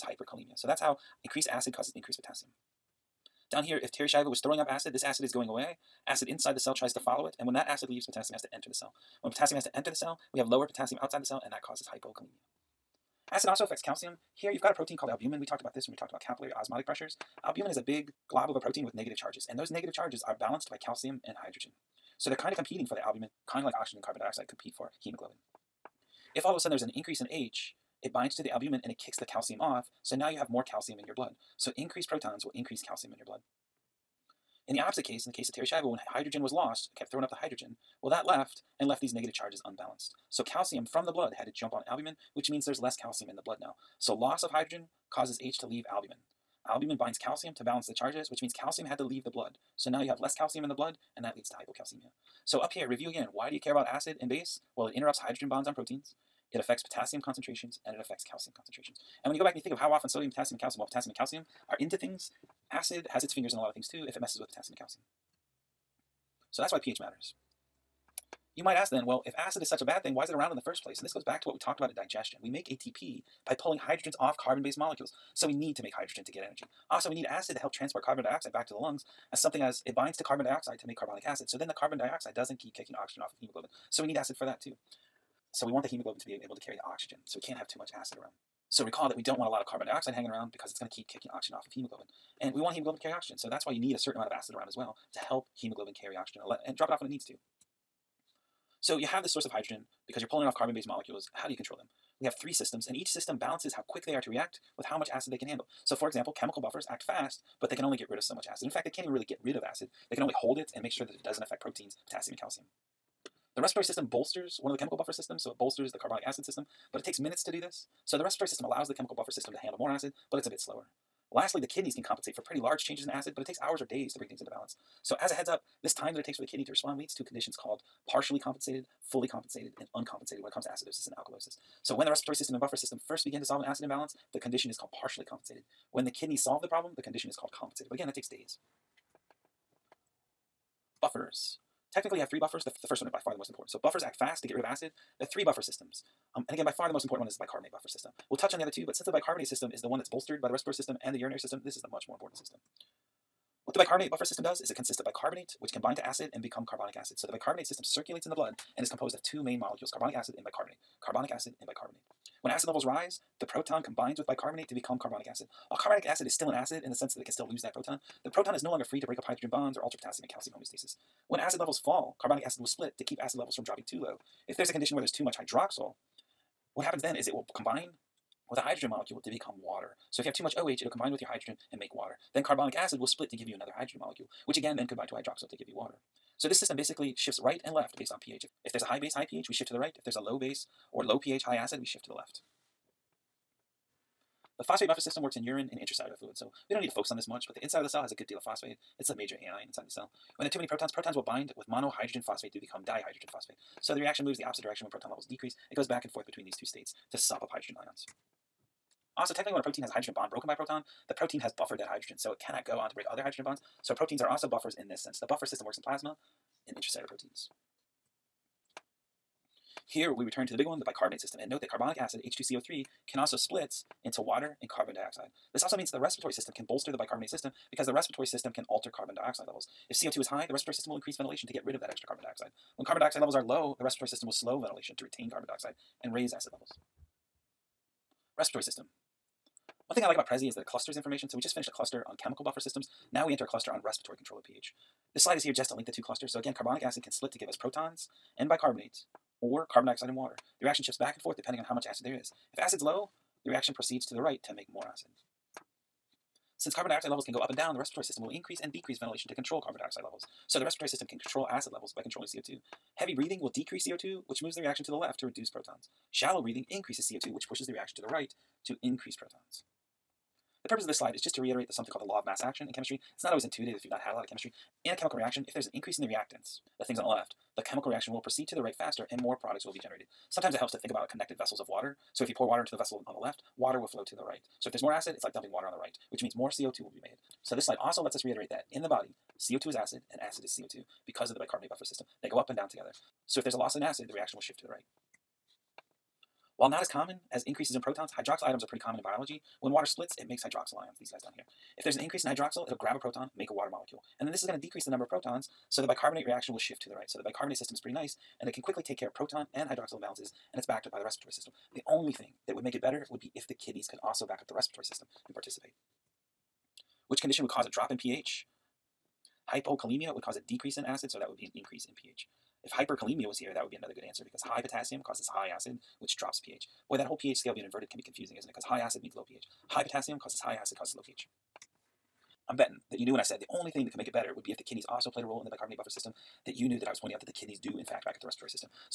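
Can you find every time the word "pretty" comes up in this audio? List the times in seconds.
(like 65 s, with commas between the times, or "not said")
122 s, 298 s, 307 s.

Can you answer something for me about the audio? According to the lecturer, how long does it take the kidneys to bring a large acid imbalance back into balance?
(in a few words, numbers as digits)
hours or days.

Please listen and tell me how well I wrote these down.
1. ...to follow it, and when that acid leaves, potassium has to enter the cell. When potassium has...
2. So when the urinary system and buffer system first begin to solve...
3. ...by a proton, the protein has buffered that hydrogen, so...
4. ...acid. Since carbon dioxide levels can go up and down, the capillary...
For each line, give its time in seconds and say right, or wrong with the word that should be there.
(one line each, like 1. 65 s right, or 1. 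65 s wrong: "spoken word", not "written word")
1. 6 s right
2. 131 s wrong: "respiratory", not "urinary"
3. 210 s right
4. 254 s wrong: "respiratory", not "capillary".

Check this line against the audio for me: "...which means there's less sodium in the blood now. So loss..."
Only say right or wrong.
wrong.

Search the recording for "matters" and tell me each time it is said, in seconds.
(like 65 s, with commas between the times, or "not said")
66 s.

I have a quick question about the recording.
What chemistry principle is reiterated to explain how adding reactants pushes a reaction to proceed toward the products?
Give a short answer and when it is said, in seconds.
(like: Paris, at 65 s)
law of mass action, at 272 s.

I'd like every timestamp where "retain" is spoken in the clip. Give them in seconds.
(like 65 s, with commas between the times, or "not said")
235 s.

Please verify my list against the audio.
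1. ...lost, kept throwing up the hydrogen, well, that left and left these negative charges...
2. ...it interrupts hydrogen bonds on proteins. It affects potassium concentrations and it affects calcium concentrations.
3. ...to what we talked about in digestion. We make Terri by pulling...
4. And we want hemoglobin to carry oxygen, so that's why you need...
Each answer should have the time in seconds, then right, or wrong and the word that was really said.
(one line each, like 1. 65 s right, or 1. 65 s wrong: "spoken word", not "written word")
1. 36 s right
2. 54 s right
3. 71 s wrong: "ATP", not "Terri"
4. 92 s right.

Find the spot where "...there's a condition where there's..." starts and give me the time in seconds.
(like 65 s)
174 s.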